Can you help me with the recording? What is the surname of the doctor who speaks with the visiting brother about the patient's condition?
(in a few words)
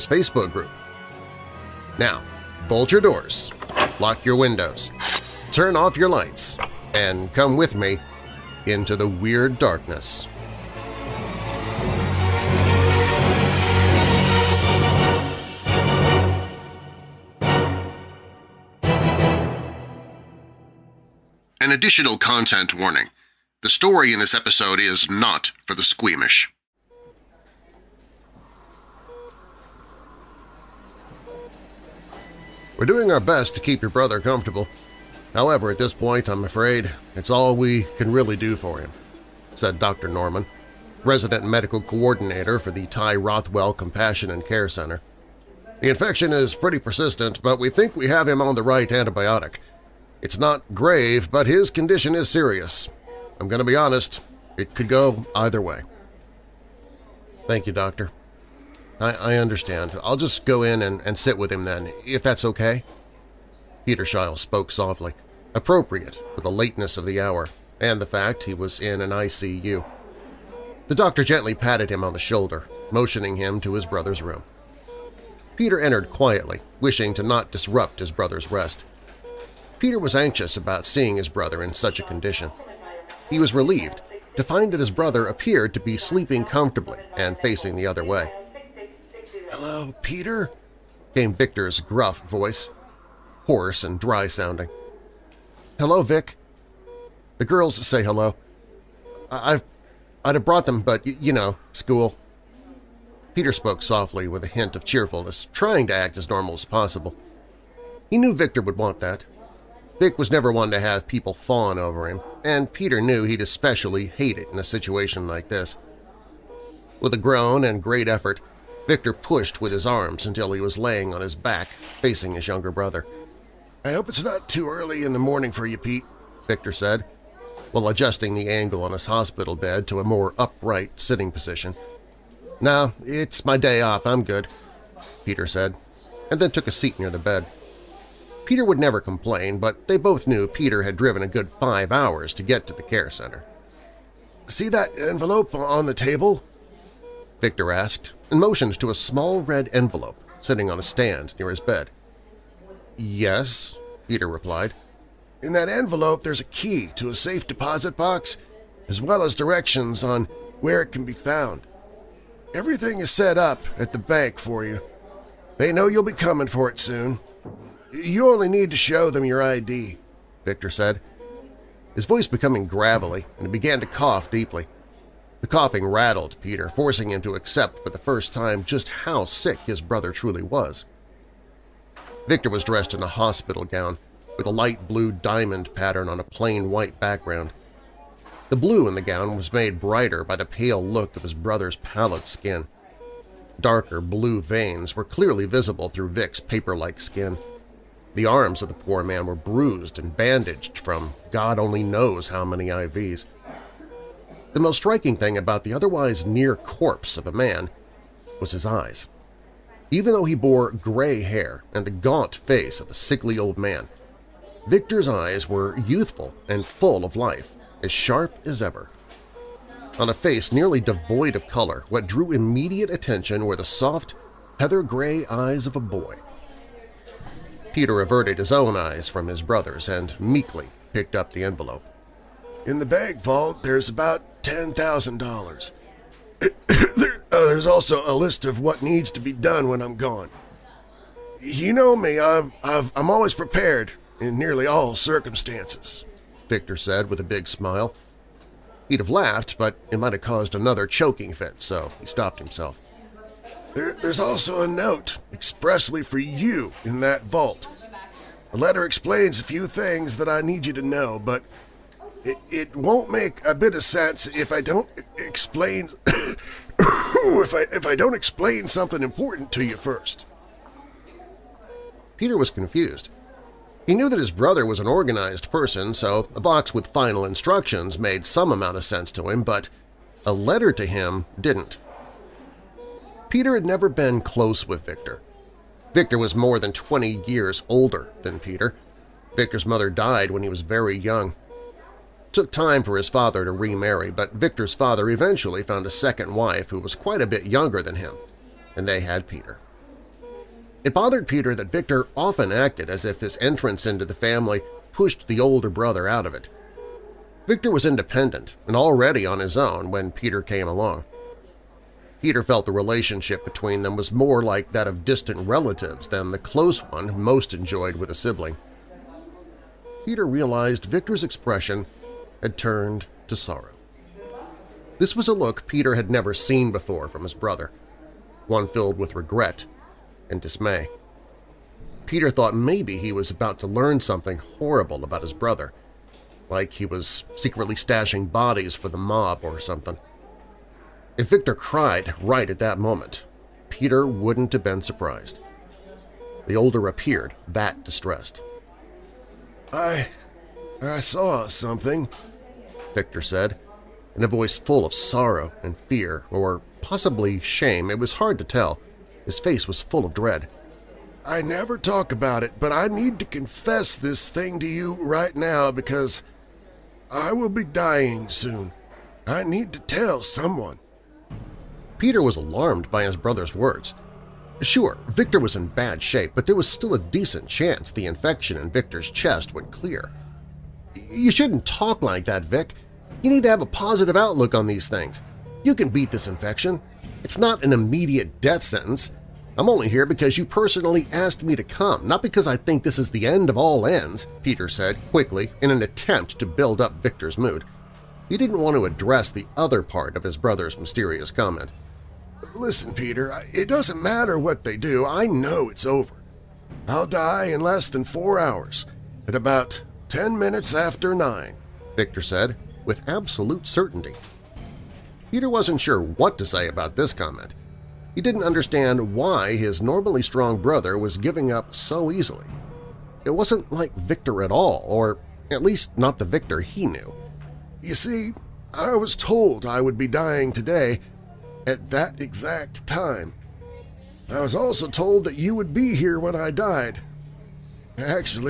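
Norman.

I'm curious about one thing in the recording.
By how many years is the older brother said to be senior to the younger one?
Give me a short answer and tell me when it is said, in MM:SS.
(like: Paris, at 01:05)
More than 20, at 04:46.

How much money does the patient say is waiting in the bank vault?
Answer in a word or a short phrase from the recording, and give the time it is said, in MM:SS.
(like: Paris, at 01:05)
$10,000, at 03:54.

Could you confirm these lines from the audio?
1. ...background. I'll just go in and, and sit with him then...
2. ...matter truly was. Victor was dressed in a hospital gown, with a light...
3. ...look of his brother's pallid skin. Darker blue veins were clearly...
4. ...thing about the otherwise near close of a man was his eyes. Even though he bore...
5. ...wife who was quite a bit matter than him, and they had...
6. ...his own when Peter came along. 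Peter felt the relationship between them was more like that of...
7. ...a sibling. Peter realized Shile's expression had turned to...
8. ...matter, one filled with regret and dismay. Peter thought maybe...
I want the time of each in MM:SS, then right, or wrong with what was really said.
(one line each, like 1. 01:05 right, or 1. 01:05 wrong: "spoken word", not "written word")
1. 00:59 wrong: "understand", not "background"
2. 02:59 wrong: "brother", not "matter"
3. 03:10 right
4. 03:25 wrong: "corpse", not "close"
5. 04:56 wrong: "younger", not "matter"
6. 05:09 right
7. 05:18 wrong: "Victor", not "Shile"
8. 05:27 wrong: "brother", not "matter".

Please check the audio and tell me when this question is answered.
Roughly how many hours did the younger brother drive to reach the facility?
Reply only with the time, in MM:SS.
02:21.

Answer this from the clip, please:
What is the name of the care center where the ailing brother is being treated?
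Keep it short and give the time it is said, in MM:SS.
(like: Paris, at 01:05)
Ty Rothwell Compassion and Care Center, at 00:42.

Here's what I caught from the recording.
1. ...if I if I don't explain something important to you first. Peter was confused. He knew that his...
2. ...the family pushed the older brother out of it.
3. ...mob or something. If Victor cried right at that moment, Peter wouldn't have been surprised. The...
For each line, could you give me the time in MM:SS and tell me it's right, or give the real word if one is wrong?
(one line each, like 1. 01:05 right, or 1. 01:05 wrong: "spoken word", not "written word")
1. 04:26 right
2. 05:04 right
3. 05:38 right.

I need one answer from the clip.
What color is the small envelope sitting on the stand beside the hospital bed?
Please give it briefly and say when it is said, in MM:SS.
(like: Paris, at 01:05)
Red, at 02:29.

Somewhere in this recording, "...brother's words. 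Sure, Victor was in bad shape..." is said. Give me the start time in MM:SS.
06:13.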